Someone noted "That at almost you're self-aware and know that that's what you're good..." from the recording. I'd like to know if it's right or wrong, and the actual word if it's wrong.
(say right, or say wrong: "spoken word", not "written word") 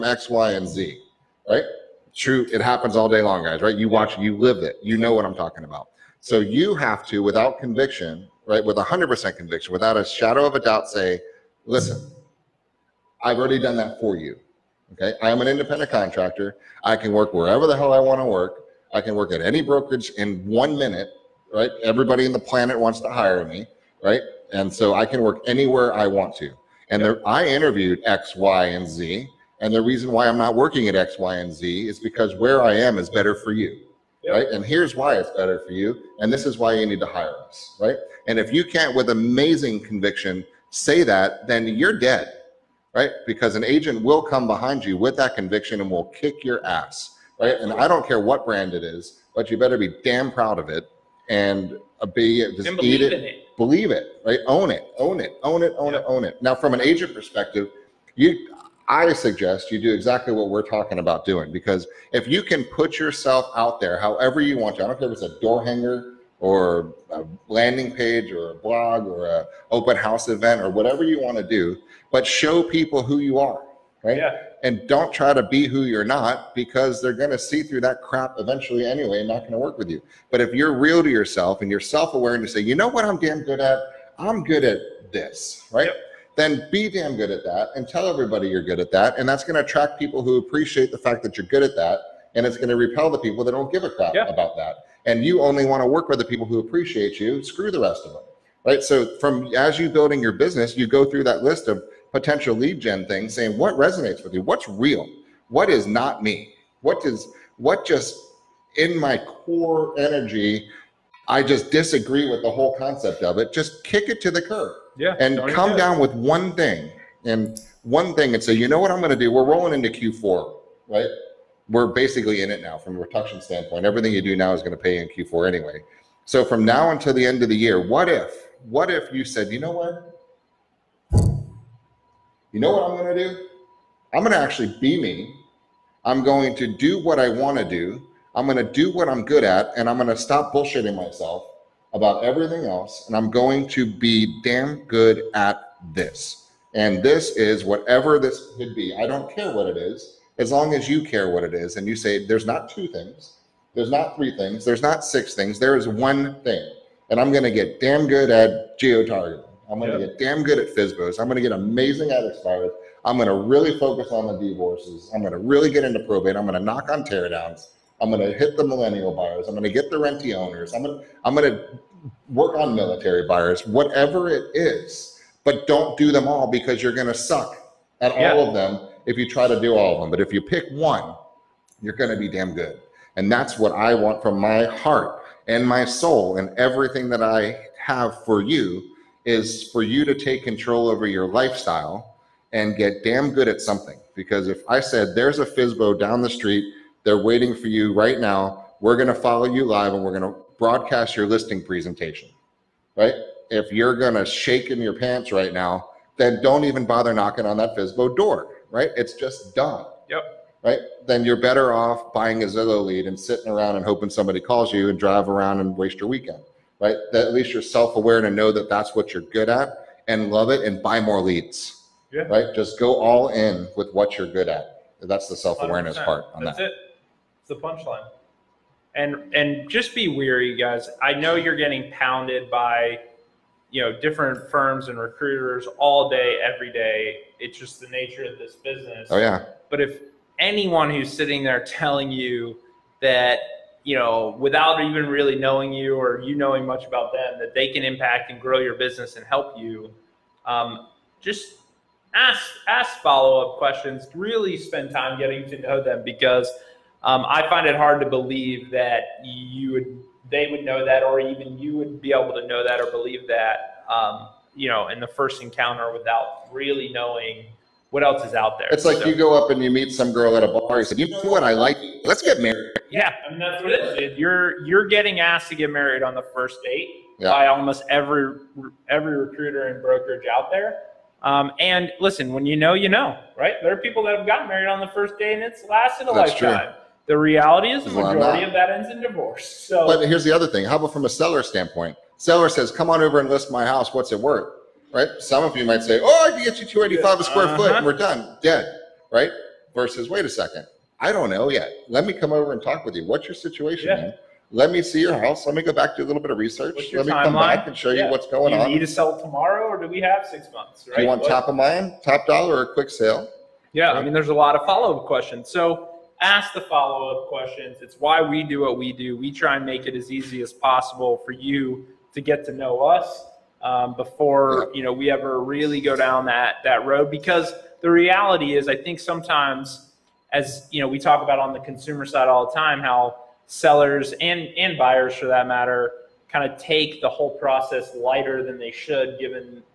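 wrong: "least", not "almost".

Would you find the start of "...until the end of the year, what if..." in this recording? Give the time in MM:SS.
02:06.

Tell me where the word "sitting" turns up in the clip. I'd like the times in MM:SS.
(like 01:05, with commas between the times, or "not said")
03:33, 04:01.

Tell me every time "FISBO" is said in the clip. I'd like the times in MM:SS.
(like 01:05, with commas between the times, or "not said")
02:40, 03:15, 03:27.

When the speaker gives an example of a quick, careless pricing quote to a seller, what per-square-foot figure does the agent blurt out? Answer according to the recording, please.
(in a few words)
285.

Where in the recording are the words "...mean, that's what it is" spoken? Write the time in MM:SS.
04:33.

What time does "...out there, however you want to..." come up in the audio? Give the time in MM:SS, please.
01:03.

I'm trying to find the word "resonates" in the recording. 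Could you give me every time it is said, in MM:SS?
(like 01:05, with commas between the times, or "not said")
01:43.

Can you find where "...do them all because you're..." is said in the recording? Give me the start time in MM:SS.
02:55.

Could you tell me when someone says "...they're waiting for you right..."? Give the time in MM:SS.
03:17.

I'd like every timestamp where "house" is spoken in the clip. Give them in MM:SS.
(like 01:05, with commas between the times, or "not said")
01:09, 04:53, 05:05.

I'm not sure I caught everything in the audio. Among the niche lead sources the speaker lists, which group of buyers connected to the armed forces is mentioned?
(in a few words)
military buyers.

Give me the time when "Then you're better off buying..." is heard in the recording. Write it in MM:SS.
03:31.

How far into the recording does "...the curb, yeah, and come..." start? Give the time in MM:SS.
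01:54.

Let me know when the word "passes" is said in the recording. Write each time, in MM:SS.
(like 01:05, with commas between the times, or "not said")
not said.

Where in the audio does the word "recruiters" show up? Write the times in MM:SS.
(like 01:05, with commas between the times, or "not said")
03:54, 04:39.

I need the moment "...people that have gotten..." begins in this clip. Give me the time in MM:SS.
04:43.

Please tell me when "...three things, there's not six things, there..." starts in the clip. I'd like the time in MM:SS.
02:34.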